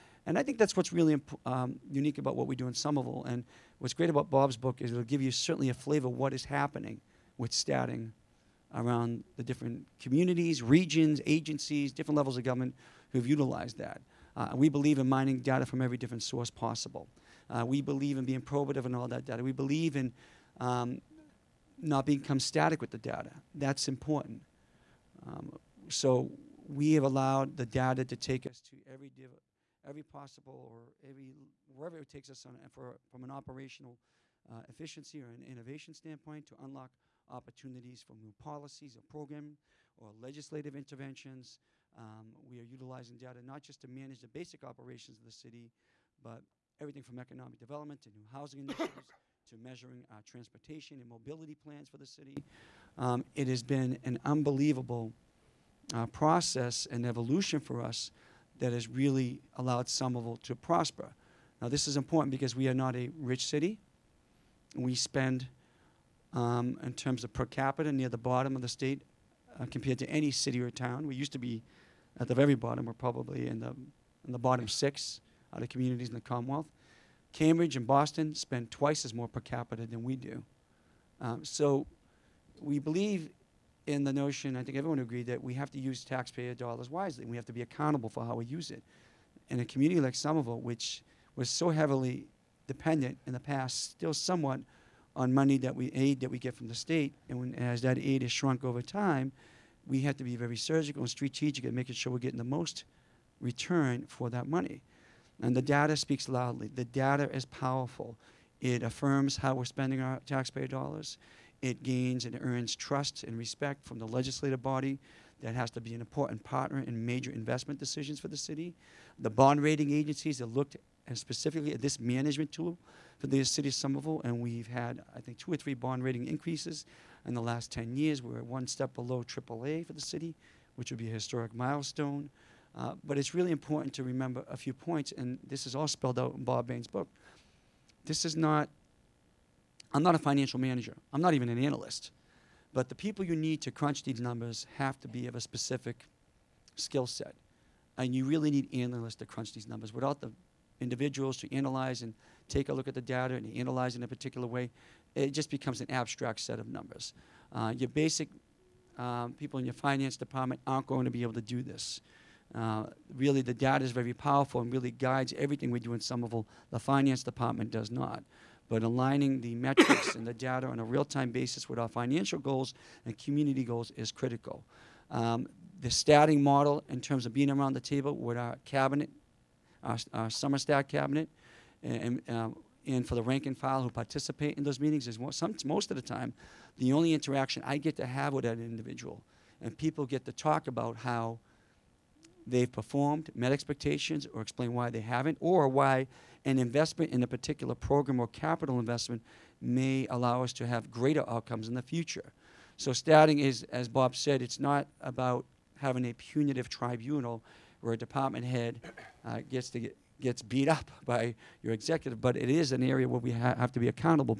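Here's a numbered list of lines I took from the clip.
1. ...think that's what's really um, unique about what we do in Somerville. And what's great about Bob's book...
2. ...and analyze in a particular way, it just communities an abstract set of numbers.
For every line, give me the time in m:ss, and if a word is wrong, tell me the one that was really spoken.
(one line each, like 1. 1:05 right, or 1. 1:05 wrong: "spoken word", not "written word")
1. 0:00 right
2. 2:33 wrong: "becomes", not "communities".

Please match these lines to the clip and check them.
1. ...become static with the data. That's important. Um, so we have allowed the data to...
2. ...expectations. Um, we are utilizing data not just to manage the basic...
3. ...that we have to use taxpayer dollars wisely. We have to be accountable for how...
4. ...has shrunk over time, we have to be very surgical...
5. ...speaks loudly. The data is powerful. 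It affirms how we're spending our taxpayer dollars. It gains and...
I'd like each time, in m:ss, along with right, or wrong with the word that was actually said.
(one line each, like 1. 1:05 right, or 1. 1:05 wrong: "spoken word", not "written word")
1. 0:22 right
2. 0:40 wrong: "interventions", not "expectations"
3. 1:25 right
4. 1:38 right
5. 1:45 right.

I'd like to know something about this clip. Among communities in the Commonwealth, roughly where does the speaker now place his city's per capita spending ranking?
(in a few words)
Bottom 6.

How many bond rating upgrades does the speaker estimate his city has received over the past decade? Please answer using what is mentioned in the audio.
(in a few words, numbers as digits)
2 or 3.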